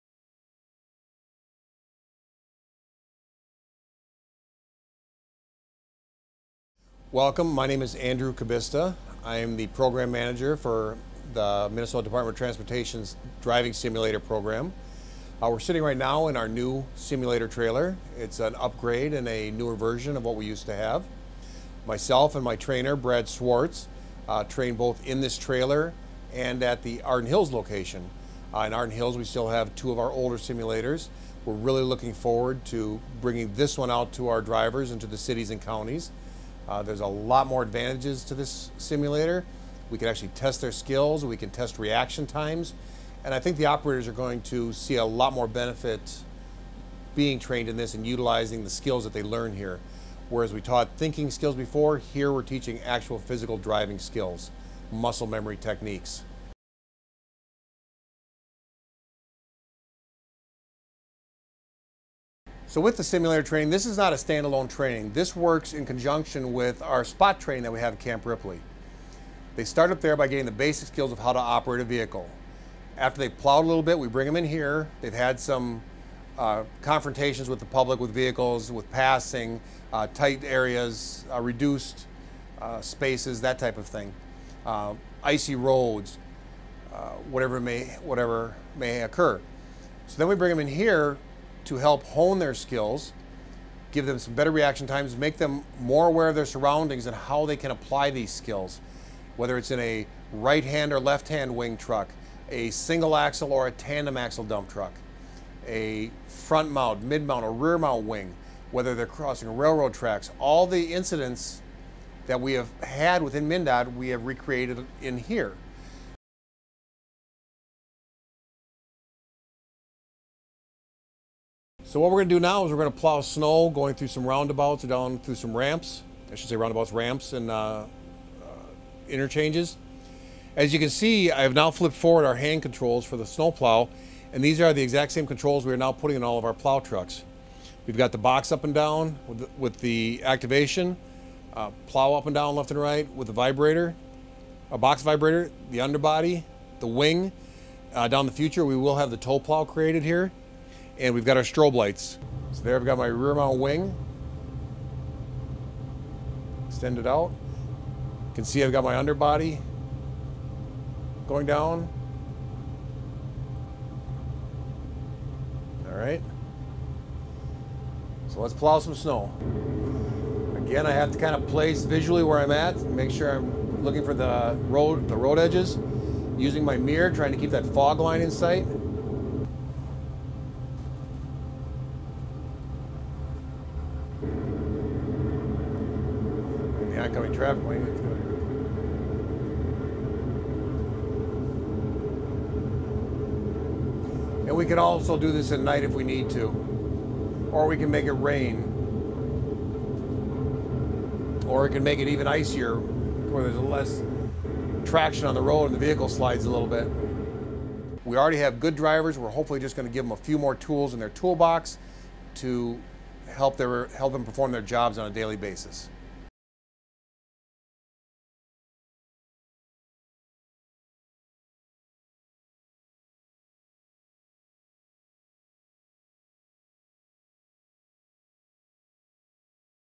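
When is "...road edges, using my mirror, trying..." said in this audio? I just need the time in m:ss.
2:55.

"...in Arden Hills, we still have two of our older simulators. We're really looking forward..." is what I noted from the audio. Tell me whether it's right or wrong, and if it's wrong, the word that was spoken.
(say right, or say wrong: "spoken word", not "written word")
right.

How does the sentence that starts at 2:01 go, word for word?
So what we're going to do now is we're going to plow snow going through some roundabouts or down through some ramps.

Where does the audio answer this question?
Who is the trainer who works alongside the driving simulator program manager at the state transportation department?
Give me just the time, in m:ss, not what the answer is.
0:22.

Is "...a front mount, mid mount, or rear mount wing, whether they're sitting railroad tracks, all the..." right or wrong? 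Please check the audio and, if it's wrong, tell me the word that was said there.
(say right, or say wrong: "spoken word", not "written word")
wrong: "crossing", not "sitting".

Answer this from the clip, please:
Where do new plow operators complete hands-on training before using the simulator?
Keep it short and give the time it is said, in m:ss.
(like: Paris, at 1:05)
Camp Ripley, at 1:07.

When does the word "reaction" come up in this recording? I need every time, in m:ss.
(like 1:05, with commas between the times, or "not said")
0:41, 1:34.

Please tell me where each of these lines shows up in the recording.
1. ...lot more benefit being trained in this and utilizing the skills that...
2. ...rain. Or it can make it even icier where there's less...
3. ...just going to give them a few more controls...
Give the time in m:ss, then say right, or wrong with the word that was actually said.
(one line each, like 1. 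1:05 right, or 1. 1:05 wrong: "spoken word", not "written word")
1. 0:45 right
2. 3:18 right
3. 3:29 wrong: "tools", not "controls".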